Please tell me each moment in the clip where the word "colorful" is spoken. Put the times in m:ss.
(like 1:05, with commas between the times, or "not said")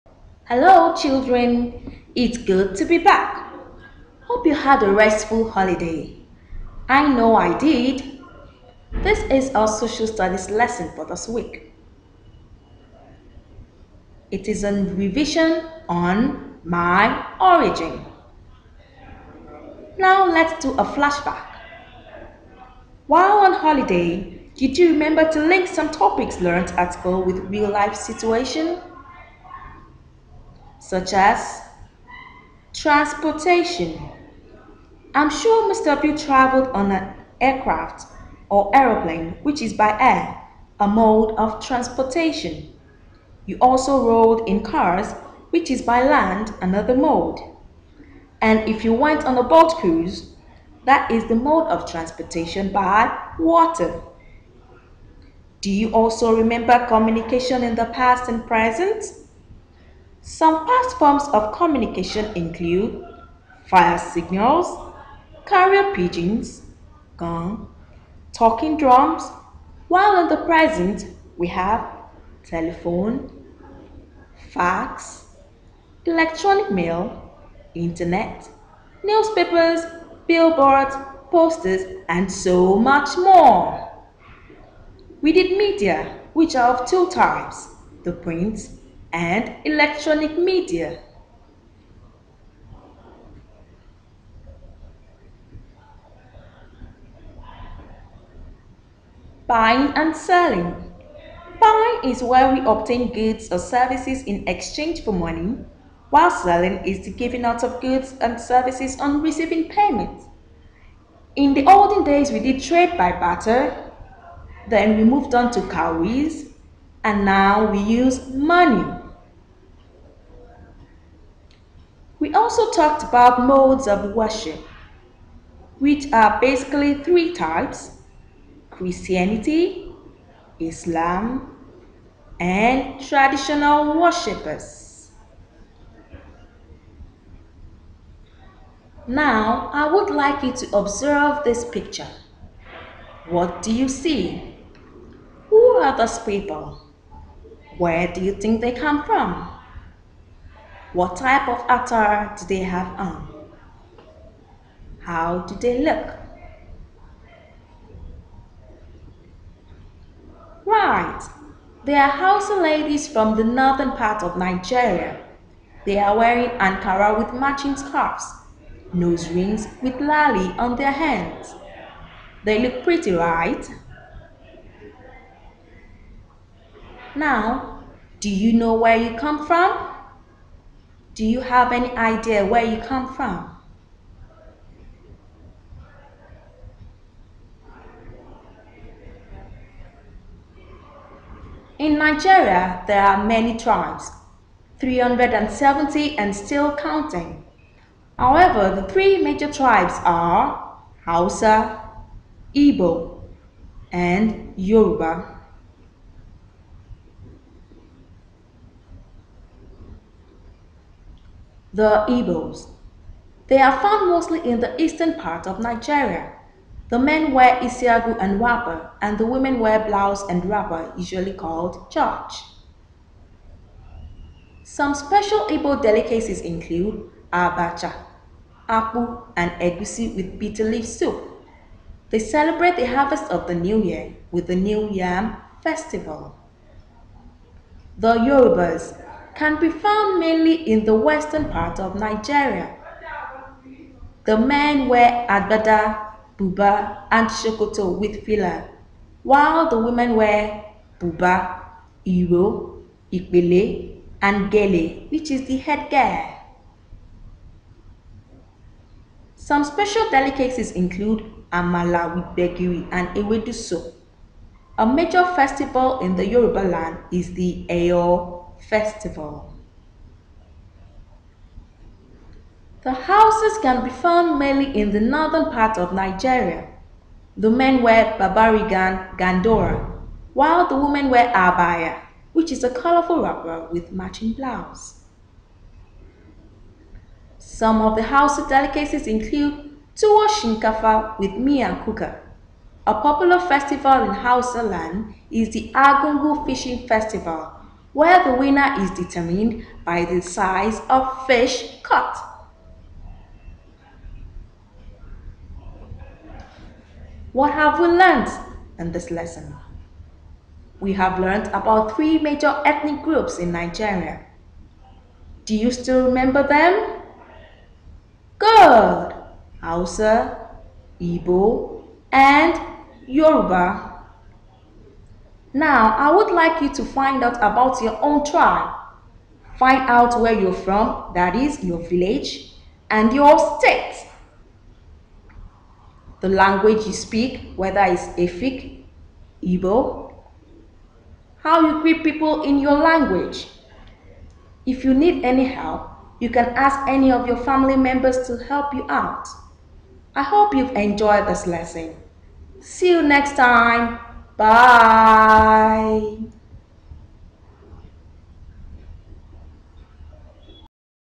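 4:42.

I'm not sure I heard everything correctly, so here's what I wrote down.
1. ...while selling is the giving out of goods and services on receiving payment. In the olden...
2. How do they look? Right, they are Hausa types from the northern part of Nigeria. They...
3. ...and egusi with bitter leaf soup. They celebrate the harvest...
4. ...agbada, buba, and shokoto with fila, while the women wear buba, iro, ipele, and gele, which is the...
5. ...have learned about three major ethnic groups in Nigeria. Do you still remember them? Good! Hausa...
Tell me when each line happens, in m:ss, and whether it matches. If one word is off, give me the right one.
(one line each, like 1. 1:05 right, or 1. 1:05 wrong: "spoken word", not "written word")
1. 1:46 right
2. 2:34 wrong: "ladies", not "types"
3. 3:49 right
4. 4:05 right
5. 5:10 right.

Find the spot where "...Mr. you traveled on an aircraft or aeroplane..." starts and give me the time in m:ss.
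0:35.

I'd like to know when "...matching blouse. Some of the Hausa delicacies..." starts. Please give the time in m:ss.
4:43.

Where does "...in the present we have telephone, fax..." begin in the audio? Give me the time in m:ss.
1:10.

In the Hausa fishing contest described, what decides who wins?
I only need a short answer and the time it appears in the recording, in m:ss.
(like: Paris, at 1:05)
size of fish, at 5:00.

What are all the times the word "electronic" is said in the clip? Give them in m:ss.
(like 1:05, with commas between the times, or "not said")
1:16, 1:29.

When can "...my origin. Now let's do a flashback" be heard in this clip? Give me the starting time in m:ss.
0:16.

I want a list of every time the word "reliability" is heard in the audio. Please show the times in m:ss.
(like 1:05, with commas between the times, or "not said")
not said.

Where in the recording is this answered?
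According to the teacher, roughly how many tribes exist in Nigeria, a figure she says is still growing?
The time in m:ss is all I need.
3:14.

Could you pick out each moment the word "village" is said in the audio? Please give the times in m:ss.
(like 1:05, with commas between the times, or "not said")
5:31.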